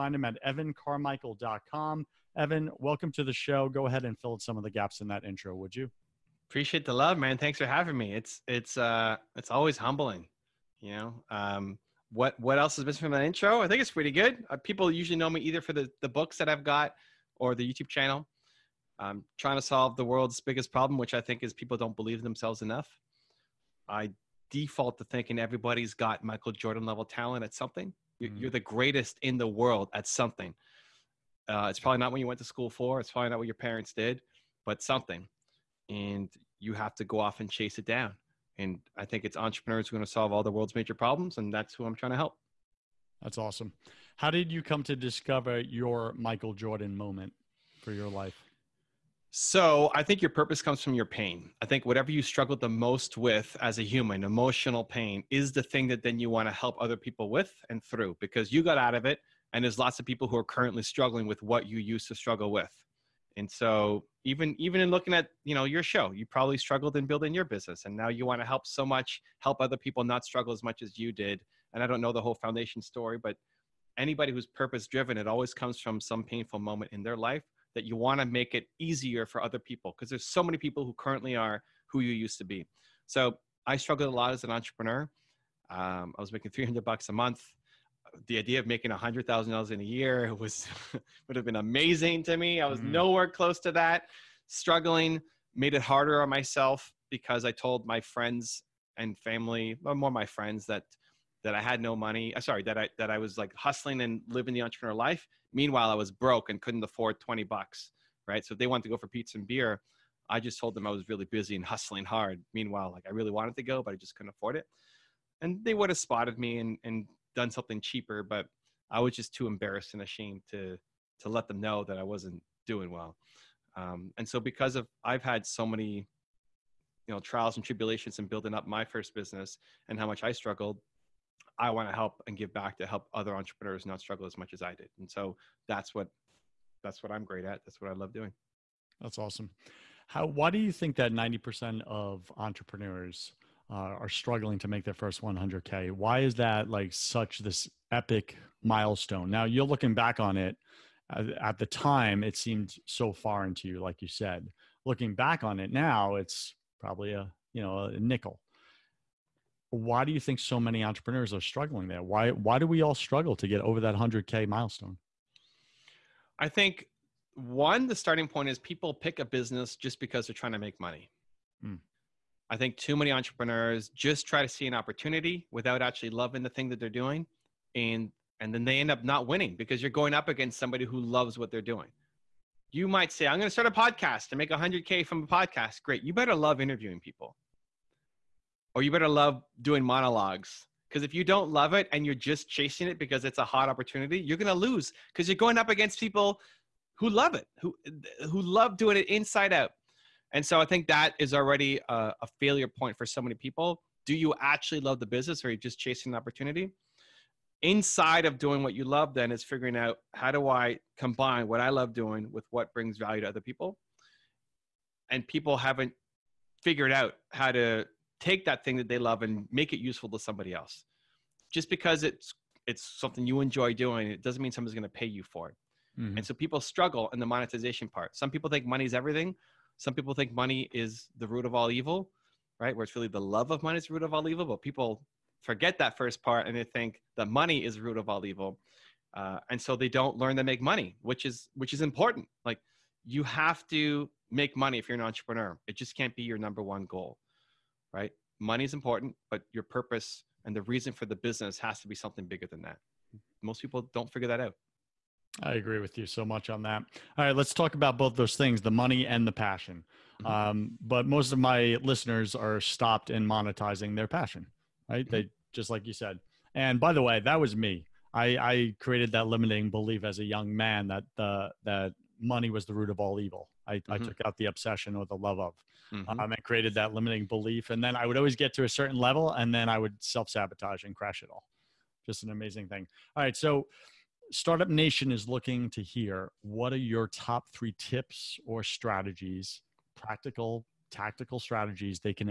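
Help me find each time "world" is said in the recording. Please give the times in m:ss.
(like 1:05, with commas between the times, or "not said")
0:20, 0:29, 0:40.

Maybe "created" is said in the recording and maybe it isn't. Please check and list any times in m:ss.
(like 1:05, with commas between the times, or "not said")
4:28, 4:36.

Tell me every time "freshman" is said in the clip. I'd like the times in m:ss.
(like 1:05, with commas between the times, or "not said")
not said.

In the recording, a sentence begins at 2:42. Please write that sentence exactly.
Why why do we all struggle to get over that 100k milestone?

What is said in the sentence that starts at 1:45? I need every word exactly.
Meanwhile, I was broke and couldn't afford twenty bucks.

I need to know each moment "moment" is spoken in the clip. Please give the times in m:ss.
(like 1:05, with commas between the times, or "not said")
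0:46, 1:16.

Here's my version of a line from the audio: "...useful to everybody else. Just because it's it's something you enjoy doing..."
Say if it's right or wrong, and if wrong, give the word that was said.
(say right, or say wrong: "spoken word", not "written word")
wrong: "somebody", not "everybody".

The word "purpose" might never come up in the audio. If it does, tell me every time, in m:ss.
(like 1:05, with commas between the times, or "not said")
0:50, 1:14, 4:09.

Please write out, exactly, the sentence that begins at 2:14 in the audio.
And so that's what that's what I'm great at.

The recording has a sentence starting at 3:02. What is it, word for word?
You might say, I'm going to start a podcast and make 100K from a podcast.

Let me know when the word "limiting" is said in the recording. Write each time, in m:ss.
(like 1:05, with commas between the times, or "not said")
4:29, 4:36.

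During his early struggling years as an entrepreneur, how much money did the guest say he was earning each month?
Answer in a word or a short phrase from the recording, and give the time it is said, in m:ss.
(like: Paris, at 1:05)
$300, at 1:26.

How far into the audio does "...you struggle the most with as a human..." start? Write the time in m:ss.
0:52.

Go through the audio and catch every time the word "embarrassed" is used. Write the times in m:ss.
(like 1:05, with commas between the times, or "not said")
1:59.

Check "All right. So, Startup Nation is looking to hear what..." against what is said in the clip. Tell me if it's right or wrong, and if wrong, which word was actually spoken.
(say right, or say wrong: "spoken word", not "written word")
right.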